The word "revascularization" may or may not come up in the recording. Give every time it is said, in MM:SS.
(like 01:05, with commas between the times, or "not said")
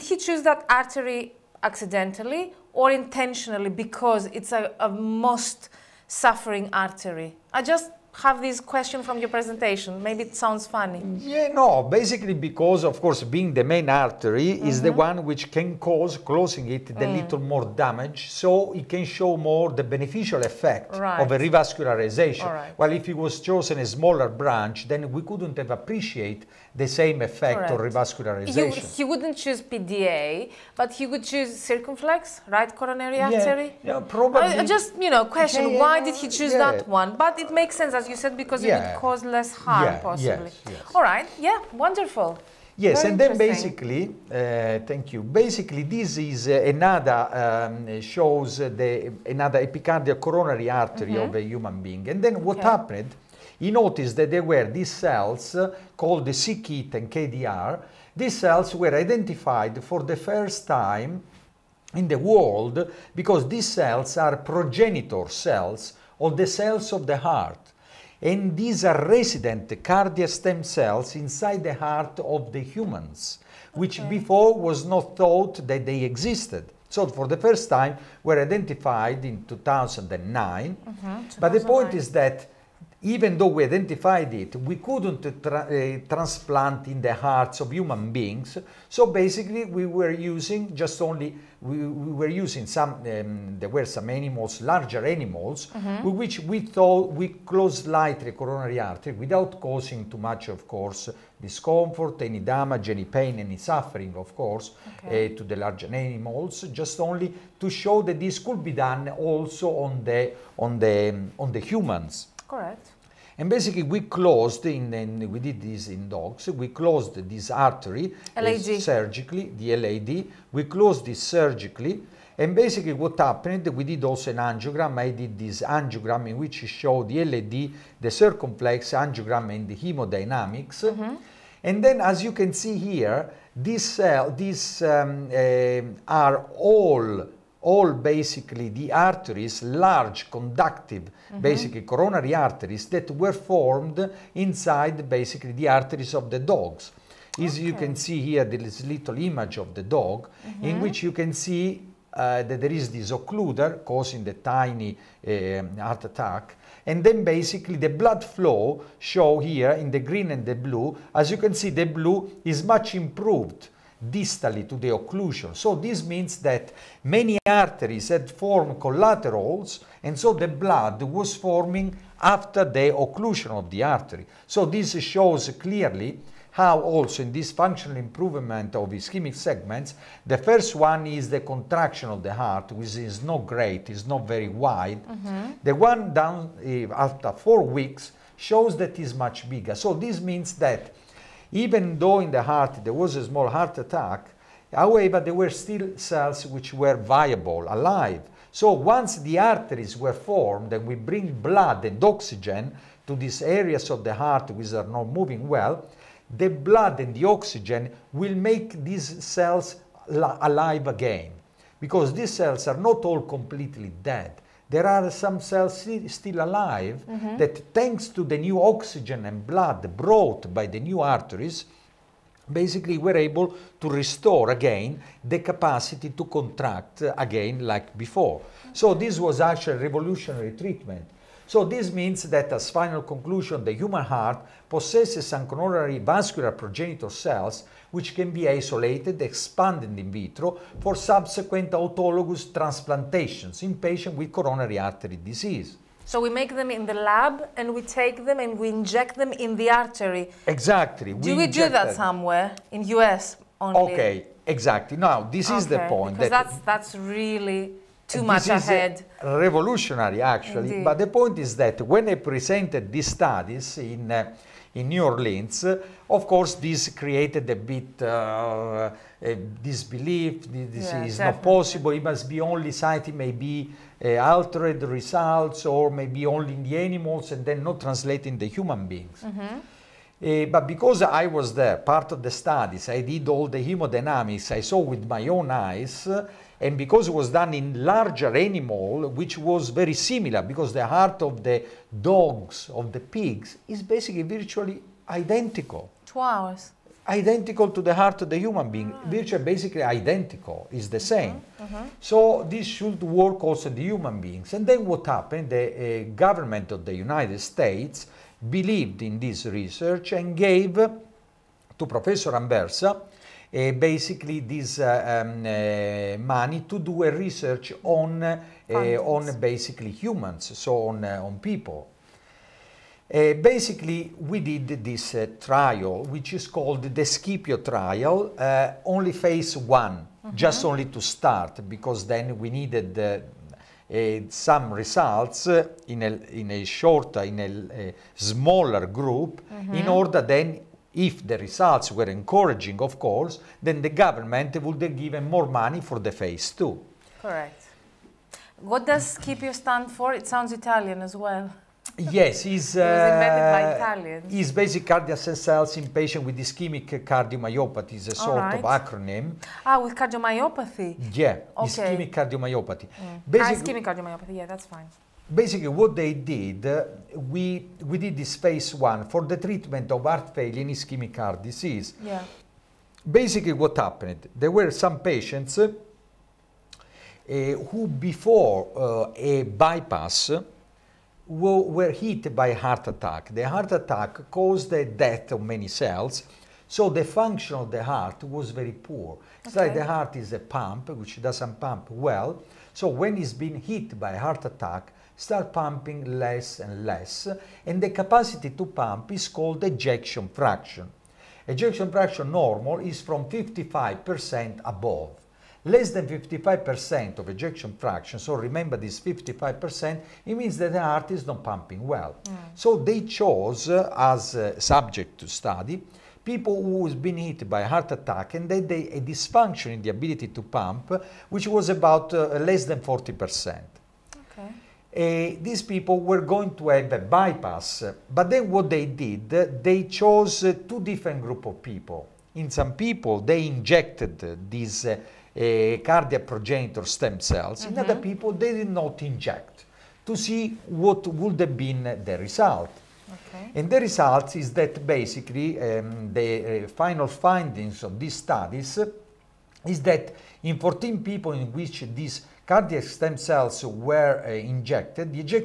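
00:21, 00:27.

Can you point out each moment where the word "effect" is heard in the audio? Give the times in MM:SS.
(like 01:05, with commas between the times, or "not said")
00:20, 00:27.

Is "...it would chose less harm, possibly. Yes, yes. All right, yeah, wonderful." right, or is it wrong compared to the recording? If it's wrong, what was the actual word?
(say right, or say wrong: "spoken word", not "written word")
wrong: "cause", not "chose".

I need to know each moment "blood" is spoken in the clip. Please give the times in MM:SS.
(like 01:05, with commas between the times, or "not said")
02:37, 02:50, 03:21, 03:26, 03:39.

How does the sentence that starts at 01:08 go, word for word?
And these are resident cardiac stem cells inside the heart of the humans, which okay.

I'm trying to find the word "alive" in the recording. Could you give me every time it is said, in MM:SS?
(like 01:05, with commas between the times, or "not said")
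03:17, 03:30, 03:36.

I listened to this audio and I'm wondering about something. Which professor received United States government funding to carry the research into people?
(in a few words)
Anversa.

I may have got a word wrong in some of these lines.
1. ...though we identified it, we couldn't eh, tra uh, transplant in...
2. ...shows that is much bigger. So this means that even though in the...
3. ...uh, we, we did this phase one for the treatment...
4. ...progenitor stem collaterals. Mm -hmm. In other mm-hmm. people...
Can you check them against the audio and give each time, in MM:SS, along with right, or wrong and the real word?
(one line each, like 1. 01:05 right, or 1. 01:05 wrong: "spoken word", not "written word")
1. 01:23 right
2. 03:08 right
3. 06:06 right
4. 07:16 wrong: "cells", not "collaterals".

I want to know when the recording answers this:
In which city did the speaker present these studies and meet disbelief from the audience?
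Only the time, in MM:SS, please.
04:24.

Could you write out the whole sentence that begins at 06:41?
Ejection fraction normal is from 55% above.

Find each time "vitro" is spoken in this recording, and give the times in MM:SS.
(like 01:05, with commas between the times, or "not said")
04:00.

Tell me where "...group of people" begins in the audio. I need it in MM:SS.
07:11.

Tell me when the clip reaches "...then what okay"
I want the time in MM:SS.
00:52.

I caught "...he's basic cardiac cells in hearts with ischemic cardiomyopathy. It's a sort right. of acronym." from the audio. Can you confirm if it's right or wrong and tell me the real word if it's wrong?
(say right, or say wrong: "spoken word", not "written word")
wrong: "patients", not "hearts".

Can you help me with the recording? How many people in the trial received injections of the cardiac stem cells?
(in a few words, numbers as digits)
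14.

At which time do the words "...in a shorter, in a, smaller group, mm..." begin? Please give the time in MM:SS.
05:36.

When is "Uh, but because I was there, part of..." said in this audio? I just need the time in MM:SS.
04:40.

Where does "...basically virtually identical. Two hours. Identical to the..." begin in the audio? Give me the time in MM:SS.
04:53.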